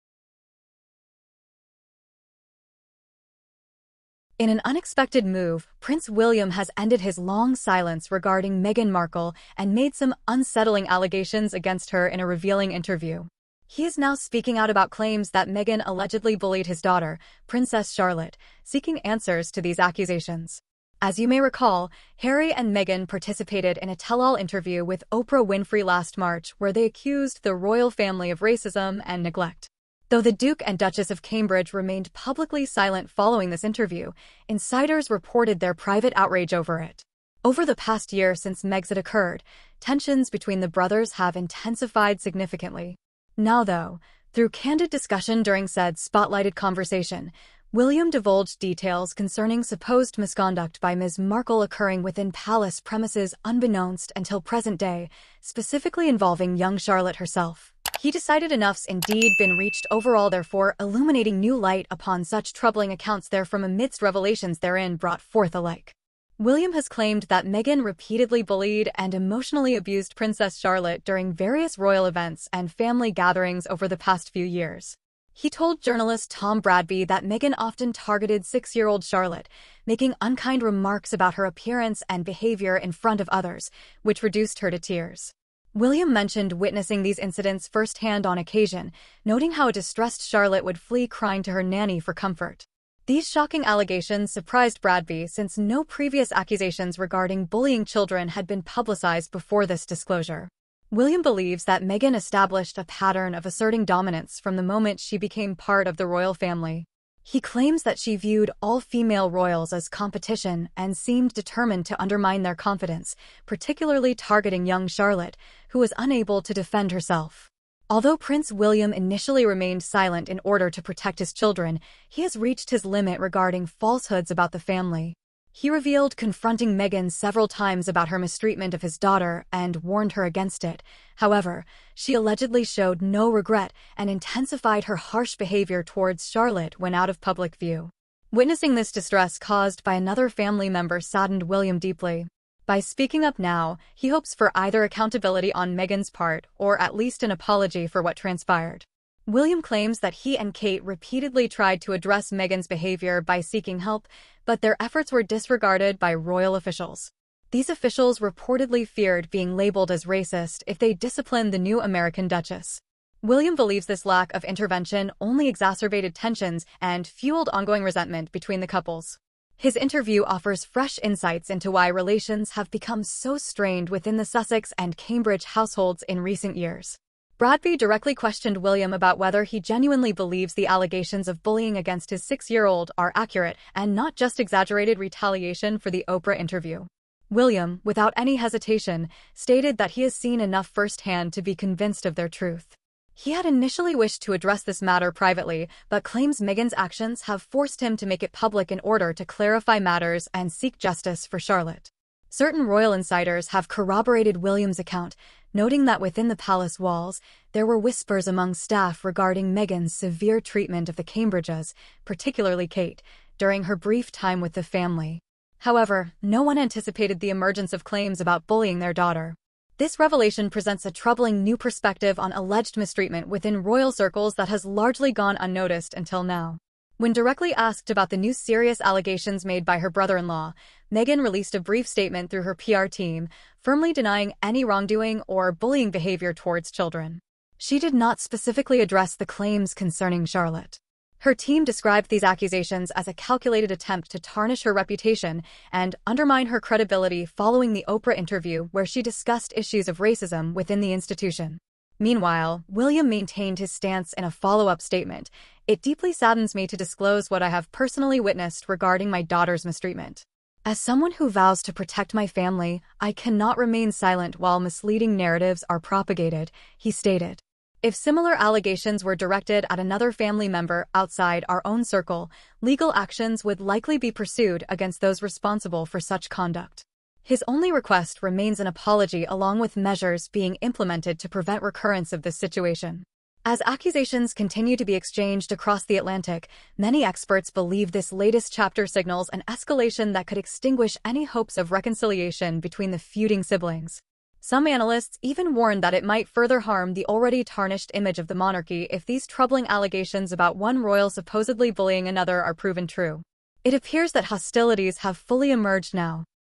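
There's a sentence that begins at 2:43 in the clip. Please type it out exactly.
William believes this lack of intervention only exacerbated tensions and fueled ongoing resentment between the couples.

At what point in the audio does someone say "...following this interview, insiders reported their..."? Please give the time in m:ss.
0:33.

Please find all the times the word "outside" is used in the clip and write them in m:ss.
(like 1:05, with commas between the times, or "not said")
4:30.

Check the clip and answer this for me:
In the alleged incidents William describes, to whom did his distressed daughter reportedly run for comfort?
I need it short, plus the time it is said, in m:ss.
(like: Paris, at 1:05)
Her nanny, at 1:31.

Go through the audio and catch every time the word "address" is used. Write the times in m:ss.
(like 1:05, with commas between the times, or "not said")
2:31, 3:14, 3:58.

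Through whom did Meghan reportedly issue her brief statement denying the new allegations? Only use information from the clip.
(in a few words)
Her PR team.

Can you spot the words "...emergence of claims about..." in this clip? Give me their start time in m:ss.
3:37.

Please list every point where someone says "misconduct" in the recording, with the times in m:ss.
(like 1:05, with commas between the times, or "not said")
0:50.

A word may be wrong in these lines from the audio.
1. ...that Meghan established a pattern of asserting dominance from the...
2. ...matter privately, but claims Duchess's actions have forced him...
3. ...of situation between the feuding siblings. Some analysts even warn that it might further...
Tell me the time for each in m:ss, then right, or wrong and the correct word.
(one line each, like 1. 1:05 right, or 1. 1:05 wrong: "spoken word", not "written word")
1. 1:41 right
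2. 3:14 wrong: "Meghan", not "Duchess"
3. 4:51 wrong: "reconciliation", not "situation".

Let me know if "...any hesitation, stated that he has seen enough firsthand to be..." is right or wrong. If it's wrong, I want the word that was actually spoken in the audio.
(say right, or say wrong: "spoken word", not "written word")
right.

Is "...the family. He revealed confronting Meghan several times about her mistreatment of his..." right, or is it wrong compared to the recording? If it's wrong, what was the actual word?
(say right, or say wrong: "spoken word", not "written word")
right.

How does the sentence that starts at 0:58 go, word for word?
He decided enough's indeed been reached overall therefore illuminating new light upon such troubling accounts therefrom amidst revelations therein brought forth alike.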